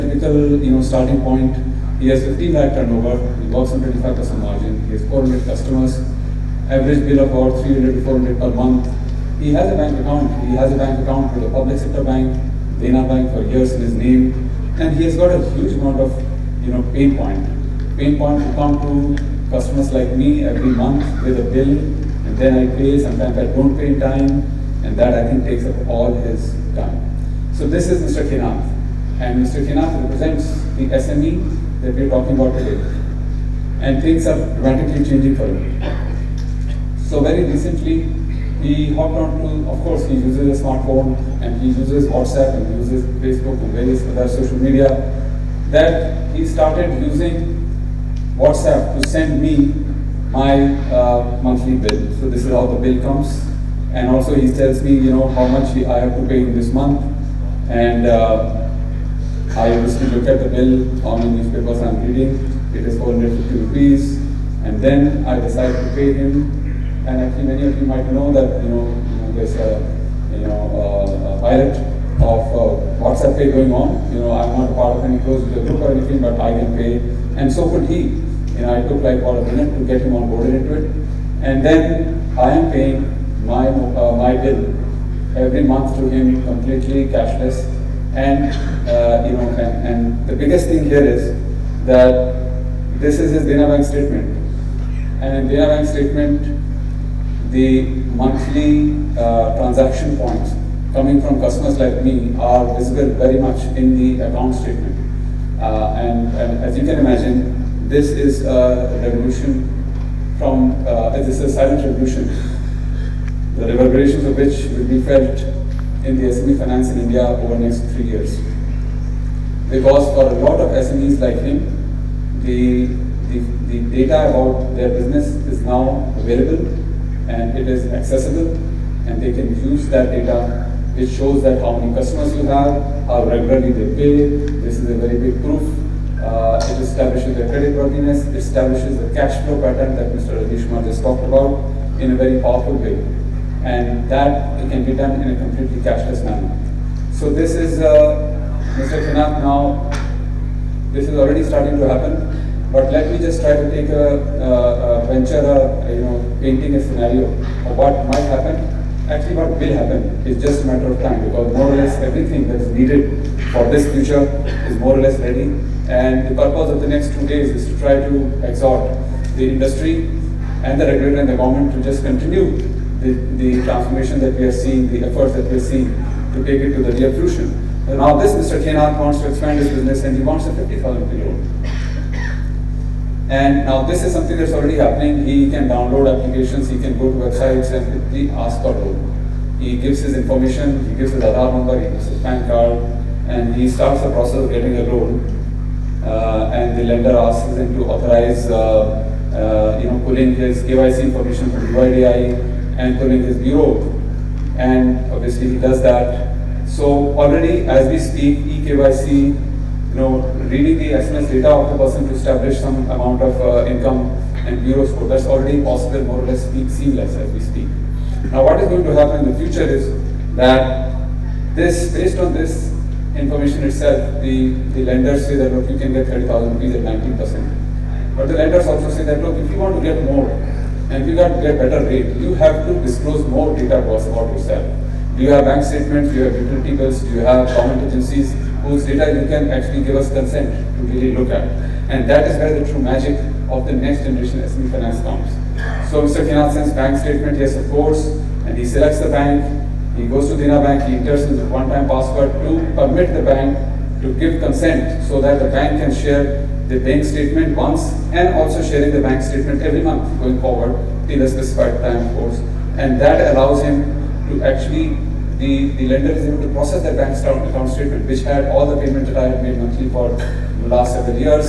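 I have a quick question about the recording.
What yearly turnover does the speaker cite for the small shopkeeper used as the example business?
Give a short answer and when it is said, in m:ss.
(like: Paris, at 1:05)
15 lakh, at 0:02.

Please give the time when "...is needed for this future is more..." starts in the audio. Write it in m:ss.
2:42.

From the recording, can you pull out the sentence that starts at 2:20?
Rajesh just talked about in a very powerful way and that it can be done in a completely cashless manner.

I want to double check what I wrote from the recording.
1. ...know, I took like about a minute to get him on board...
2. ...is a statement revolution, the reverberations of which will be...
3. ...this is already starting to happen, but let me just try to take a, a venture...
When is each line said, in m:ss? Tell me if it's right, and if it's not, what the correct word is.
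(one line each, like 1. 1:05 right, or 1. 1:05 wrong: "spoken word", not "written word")
1. 1:18 right
2. 1:51 wrong: "silent", not "statement"
3. 2:30 right.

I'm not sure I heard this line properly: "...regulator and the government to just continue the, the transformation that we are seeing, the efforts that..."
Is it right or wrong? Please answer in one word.
right.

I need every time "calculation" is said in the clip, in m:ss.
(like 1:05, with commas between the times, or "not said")
not said.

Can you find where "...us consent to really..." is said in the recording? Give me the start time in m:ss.
3:59.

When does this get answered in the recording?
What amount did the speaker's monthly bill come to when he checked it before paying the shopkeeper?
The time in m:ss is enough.
1:02.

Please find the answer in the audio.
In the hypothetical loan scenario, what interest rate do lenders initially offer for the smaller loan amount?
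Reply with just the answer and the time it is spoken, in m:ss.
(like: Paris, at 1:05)
19%, at 3:46.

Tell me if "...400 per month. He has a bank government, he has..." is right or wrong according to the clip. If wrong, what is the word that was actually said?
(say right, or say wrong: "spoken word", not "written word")
wrong: "account", not "government".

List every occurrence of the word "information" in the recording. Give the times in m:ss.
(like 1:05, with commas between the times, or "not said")
3:10, 3:21, 3:43.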